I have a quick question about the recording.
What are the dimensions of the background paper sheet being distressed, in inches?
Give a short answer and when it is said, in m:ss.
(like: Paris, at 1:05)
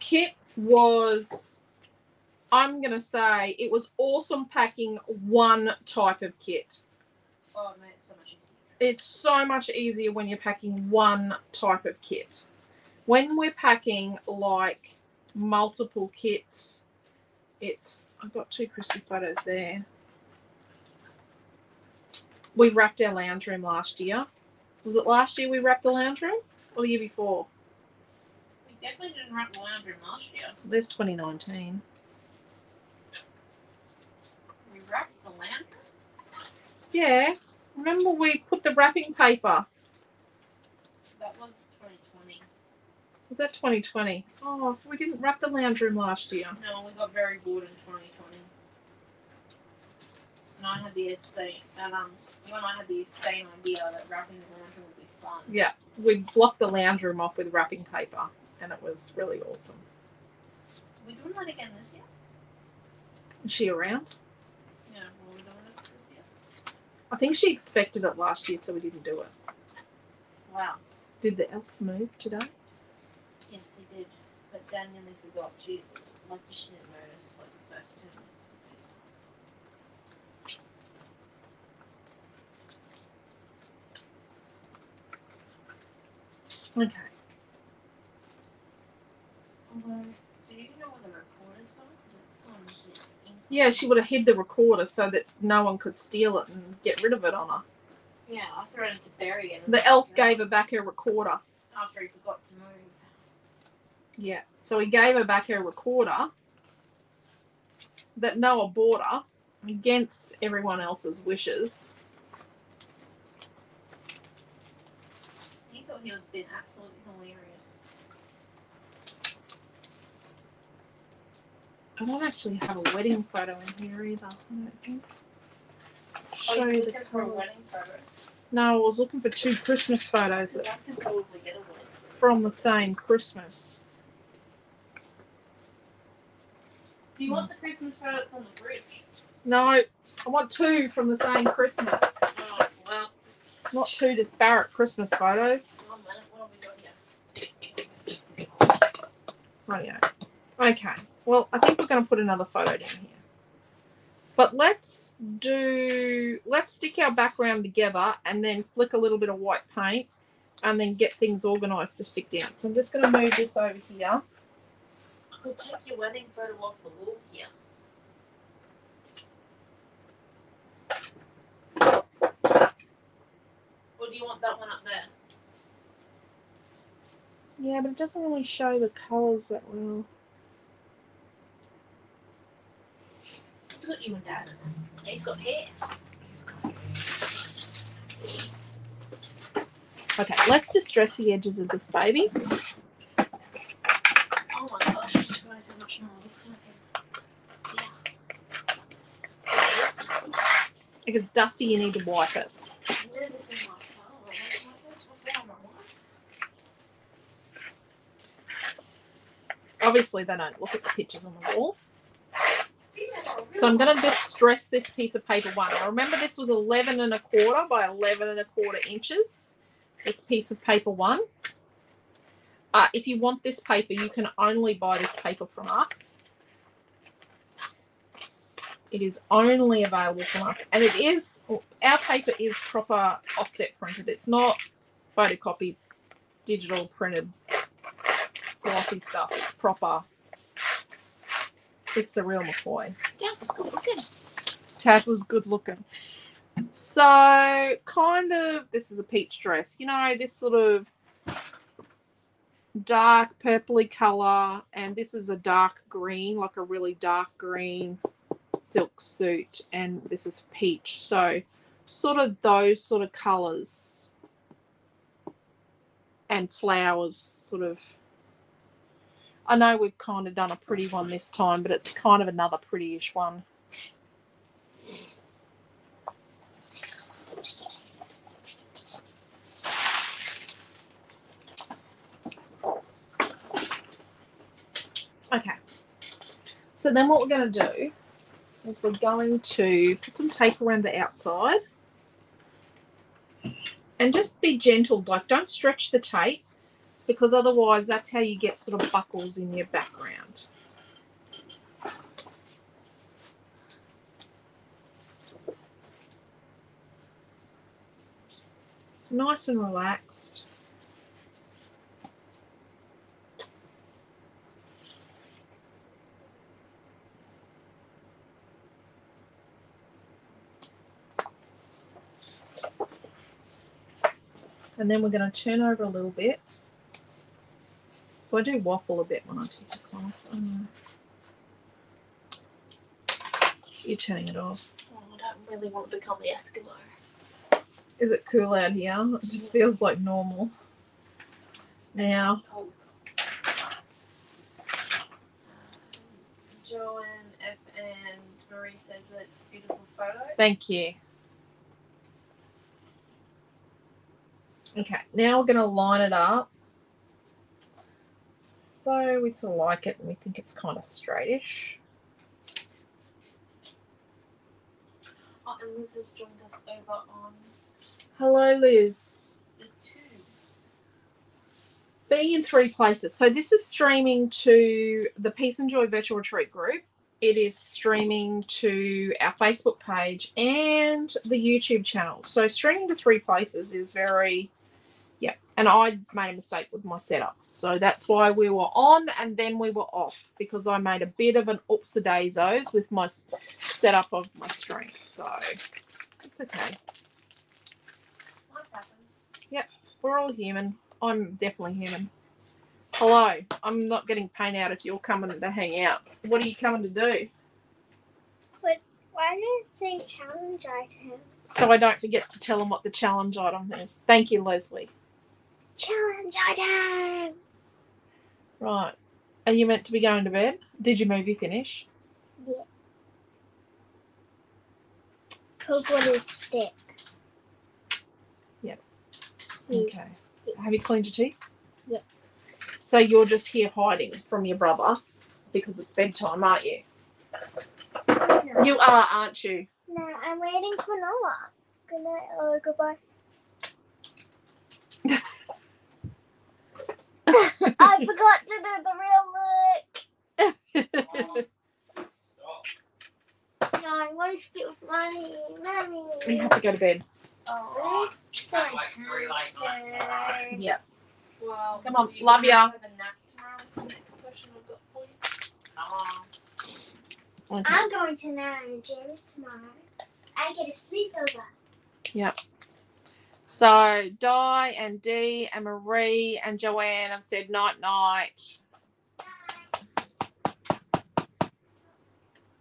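11 1/4 by 11 1/4, at 3:36.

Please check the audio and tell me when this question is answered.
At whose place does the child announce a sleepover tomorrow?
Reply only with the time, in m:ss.
7:48.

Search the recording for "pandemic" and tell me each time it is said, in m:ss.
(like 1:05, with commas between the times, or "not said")
not said.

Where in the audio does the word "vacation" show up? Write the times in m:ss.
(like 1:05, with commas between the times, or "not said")
not said.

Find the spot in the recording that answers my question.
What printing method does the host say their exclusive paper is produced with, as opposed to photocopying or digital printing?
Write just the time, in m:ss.
3:53.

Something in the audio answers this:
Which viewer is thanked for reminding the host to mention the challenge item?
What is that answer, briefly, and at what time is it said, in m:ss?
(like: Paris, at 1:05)
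Leslie, at 6:54.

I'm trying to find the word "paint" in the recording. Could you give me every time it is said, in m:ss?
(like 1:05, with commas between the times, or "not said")
2:39, 6:44.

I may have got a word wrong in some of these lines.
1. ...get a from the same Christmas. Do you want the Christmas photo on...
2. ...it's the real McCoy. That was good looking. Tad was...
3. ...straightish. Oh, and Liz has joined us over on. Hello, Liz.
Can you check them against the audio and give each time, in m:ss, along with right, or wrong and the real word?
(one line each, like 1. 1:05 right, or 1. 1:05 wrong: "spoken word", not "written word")
1. 2:11 right
2. 4:01 right
3. 6:00 right.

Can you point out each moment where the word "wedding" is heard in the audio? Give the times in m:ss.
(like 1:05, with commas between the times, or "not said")
2:02, 2:07, 2:45.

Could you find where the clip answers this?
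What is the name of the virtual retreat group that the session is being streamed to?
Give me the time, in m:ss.
6:15.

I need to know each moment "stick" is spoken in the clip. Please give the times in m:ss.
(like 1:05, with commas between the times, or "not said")
2:36, 2:42, 7:06.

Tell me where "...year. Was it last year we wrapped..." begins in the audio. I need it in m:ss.
0:24.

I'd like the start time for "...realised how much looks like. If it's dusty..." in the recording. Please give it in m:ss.
3:15.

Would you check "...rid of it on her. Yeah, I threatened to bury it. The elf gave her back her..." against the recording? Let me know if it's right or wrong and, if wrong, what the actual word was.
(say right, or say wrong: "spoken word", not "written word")
right.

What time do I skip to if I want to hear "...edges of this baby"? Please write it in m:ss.
3:11.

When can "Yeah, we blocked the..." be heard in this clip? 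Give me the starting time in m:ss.
0:55.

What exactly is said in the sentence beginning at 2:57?
Yeah, but it doesn't really show the colours that well.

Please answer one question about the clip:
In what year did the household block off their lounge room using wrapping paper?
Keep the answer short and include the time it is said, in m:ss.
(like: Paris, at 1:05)
2020, at 0:41.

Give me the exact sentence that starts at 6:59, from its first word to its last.
Are you meant to be going to bed?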